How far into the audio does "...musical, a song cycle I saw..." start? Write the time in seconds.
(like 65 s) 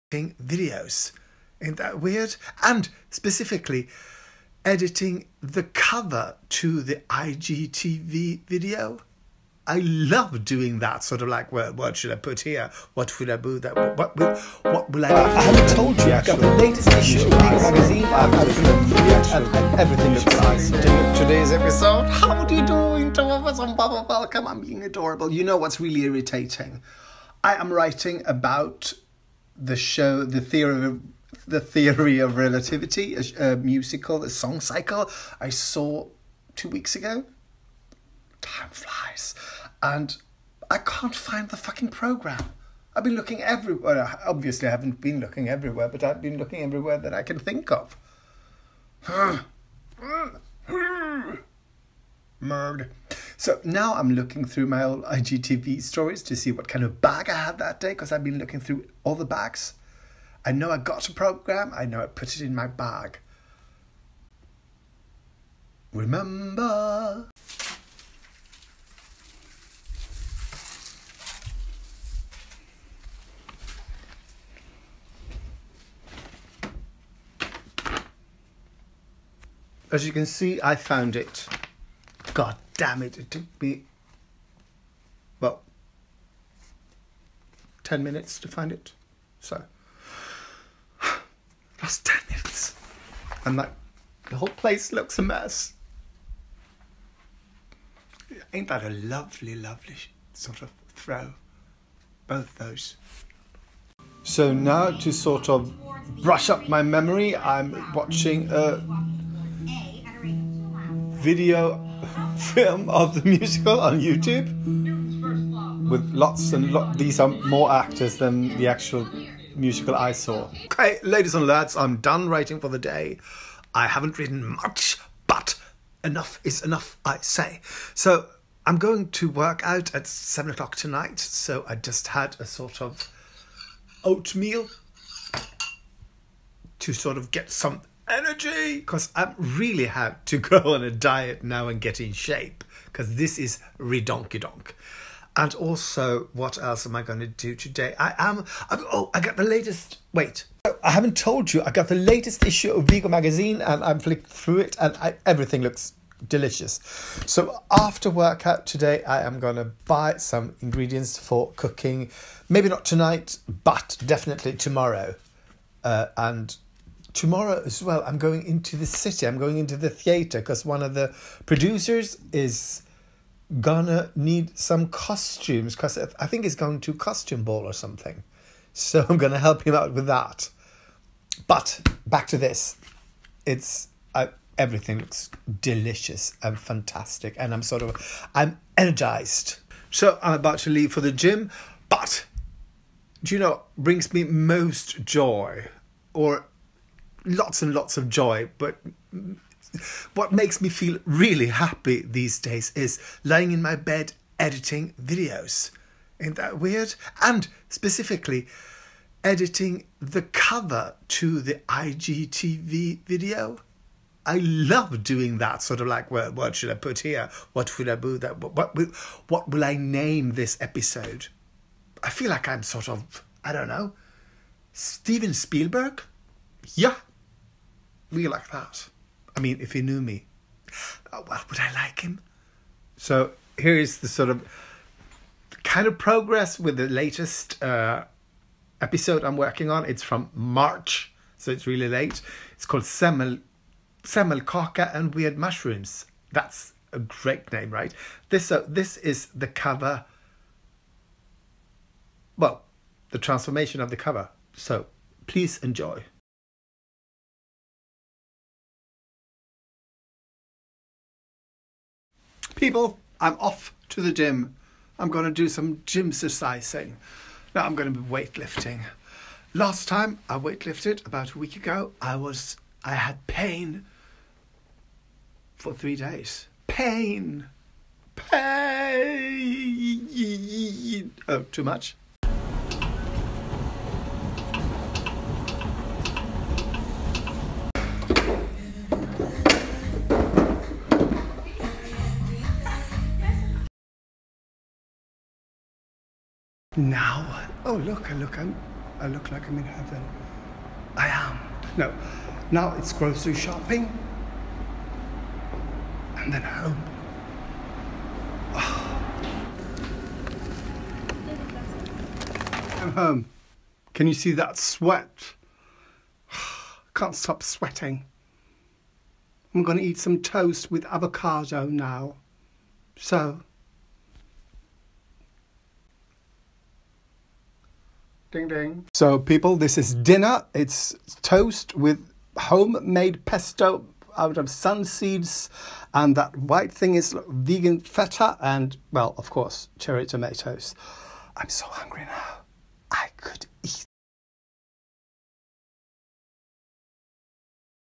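33 s.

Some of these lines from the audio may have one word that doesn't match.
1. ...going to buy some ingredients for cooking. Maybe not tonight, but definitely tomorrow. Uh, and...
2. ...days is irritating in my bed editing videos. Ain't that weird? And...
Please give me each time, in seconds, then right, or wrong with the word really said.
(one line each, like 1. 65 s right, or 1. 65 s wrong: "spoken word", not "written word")
1. 159 s right
2. 202 s wrong: "lying", not "irritating".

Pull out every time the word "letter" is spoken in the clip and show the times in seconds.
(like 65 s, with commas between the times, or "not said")
not said.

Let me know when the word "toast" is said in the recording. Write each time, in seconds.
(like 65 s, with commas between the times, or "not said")
320 s, 331 s.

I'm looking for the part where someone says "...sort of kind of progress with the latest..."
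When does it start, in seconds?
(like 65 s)
234 s.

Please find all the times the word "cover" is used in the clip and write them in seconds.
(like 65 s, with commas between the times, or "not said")
5 s, 210 s, 249 s, 253 s.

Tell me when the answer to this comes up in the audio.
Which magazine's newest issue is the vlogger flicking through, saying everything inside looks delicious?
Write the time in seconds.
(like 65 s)
152 s.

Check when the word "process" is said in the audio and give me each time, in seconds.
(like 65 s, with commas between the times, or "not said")
not said.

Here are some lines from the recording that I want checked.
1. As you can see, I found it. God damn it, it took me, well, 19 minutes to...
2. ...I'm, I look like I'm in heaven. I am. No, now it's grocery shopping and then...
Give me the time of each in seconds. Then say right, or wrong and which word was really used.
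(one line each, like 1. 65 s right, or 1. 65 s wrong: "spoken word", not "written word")
1. 79 s wrong: "10", not "19"
2. 298 s right.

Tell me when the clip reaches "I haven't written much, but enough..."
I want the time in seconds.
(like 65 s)
123 s.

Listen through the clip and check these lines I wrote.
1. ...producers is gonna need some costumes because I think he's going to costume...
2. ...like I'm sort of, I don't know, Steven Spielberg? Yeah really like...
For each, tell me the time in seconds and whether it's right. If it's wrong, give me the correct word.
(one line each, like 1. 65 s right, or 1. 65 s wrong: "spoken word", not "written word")
1. 171 s right
2. 222 s right.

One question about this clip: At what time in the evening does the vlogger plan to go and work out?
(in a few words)
7 o'clock.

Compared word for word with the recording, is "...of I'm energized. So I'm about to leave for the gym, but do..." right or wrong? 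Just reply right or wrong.
right.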